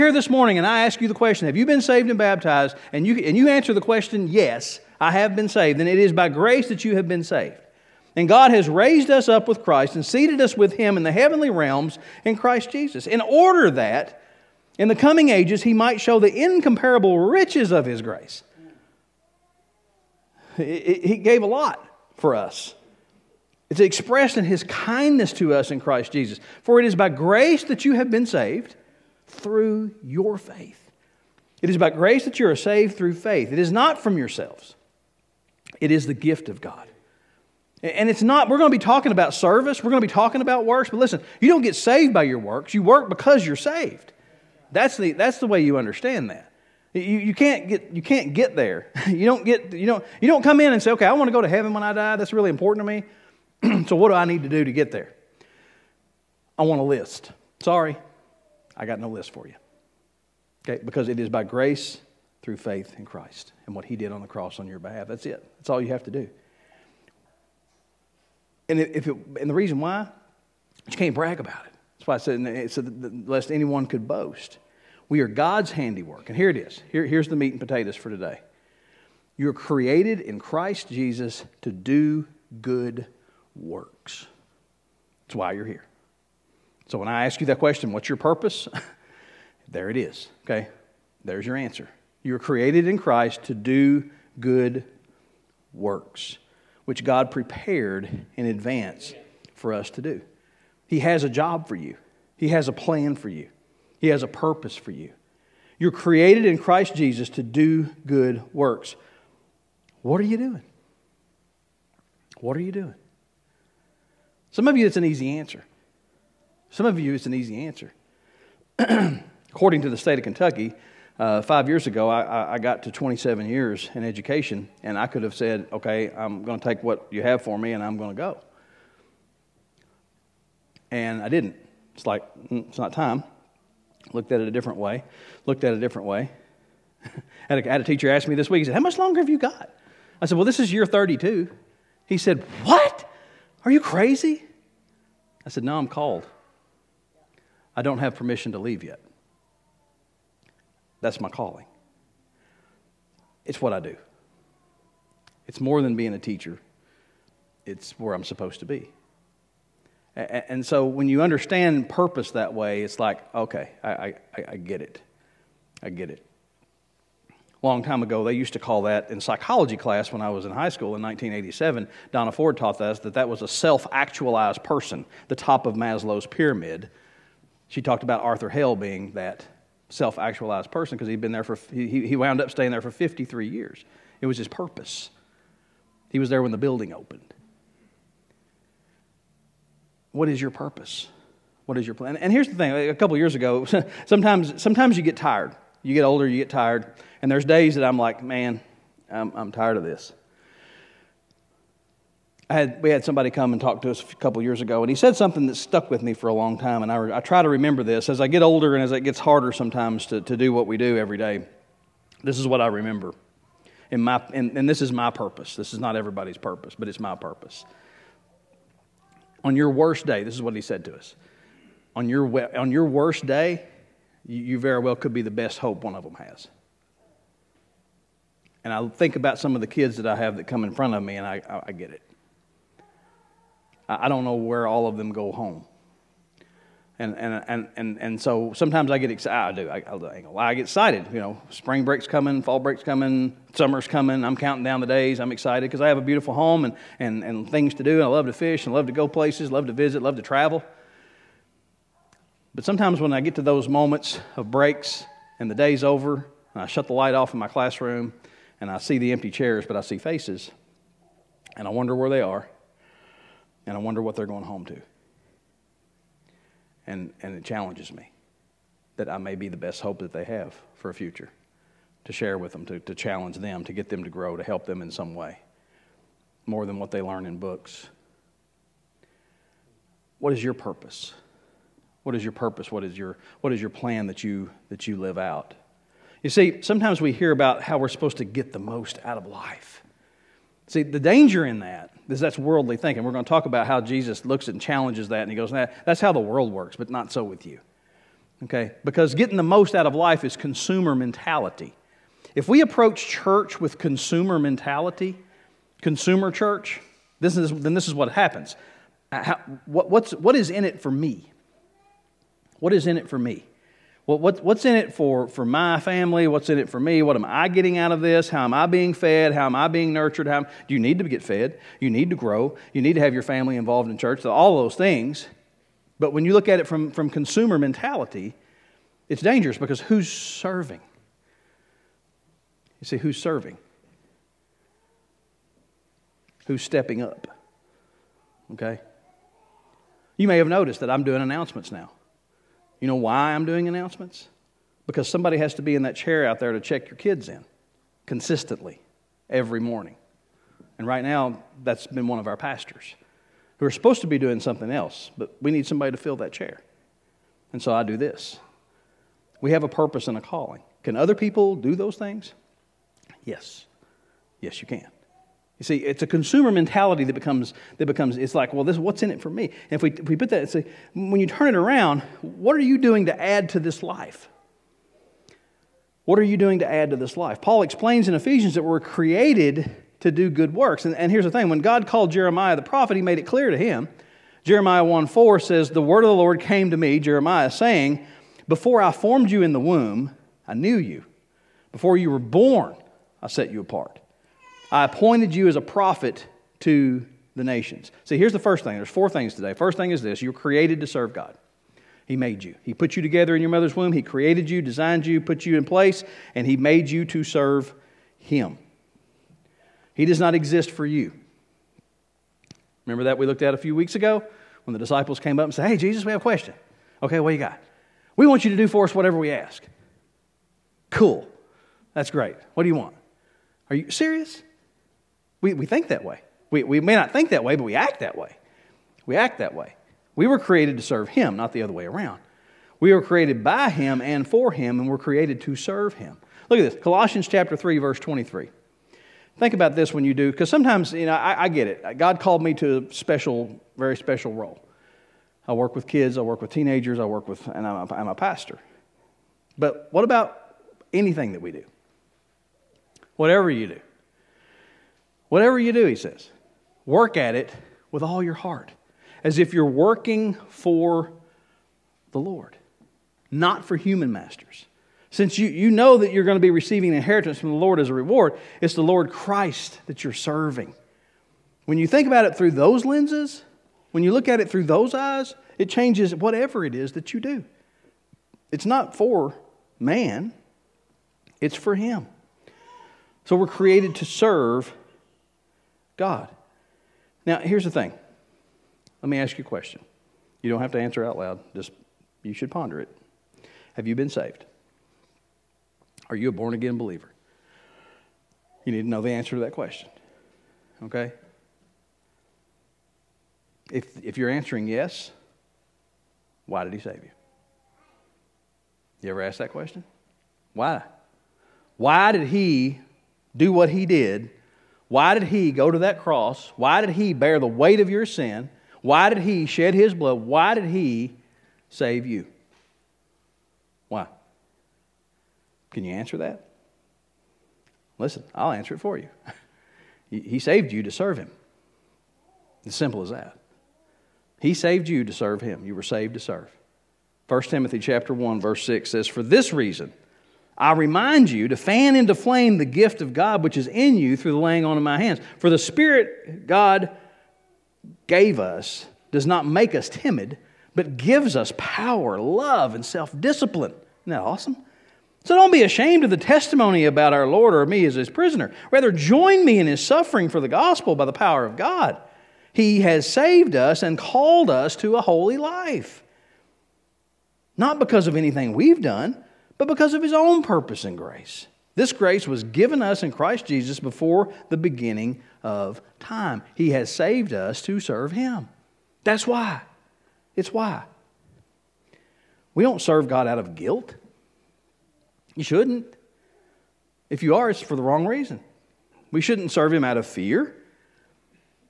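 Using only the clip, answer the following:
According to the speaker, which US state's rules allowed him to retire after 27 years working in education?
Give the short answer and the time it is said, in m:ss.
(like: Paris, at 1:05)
Kentucky, at 2:00.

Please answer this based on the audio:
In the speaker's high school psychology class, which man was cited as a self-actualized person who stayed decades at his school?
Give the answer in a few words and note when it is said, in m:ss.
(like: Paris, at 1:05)
Arthur Hale, at 2:58.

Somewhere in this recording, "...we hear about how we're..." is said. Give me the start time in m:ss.
4:47.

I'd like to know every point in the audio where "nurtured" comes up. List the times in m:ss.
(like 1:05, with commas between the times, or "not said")
5:19.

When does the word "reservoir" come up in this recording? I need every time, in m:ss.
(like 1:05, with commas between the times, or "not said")
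not said.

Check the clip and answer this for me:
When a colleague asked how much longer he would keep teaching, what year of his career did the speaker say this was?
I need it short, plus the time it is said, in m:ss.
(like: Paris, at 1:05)
32, at 2:20.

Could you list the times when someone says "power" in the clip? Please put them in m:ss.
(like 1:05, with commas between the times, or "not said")
9:11, 9:21.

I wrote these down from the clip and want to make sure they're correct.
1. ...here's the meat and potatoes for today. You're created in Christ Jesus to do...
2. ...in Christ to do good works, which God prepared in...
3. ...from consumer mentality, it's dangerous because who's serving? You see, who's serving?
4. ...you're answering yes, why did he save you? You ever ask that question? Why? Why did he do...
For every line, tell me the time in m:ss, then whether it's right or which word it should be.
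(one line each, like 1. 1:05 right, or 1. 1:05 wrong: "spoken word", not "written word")
1. 1:17 right
2. 1:32 right
3. 5:26 right
4. 8:24 right.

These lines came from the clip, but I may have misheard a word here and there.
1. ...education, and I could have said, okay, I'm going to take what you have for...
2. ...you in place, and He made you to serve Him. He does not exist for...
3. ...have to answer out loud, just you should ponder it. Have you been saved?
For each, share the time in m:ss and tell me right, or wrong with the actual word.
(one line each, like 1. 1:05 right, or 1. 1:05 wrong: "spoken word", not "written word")
1. 2:04 right
2. 6:45 right
3. 8:10 right.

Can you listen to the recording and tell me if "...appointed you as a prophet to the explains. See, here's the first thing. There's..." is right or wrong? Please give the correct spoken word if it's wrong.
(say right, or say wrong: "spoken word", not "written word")
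wrong: "nations", not "explains".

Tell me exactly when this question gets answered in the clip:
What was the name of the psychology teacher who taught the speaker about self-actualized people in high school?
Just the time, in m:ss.
2:52.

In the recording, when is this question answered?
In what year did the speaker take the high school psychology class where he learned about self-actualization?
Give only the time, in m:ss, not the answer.
2:51.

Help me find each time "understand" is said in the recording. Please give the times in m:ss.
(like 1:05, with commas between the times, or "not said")
0:45, 2:41.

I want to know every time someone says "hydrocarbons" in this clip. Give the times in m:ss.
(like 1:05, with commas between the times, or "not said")
not said.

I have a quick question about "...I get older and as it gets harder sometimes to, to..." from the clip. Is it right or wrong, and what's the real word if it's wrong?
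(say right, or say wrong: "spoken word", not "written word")
right.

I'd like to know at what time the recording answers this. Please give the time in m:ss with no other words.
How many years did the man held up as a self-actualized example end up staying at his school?
3:02.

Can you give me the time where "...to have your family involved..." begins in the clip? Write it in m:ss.
5:22.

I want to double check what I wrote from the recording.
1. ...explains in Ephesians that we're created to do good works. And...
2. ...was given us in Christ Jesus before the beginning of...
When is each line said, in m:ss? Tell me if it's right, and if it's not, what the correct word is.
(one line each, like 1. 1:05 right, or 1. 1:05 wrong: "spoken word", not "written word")
1. 6:17 right
2. 9:32 right.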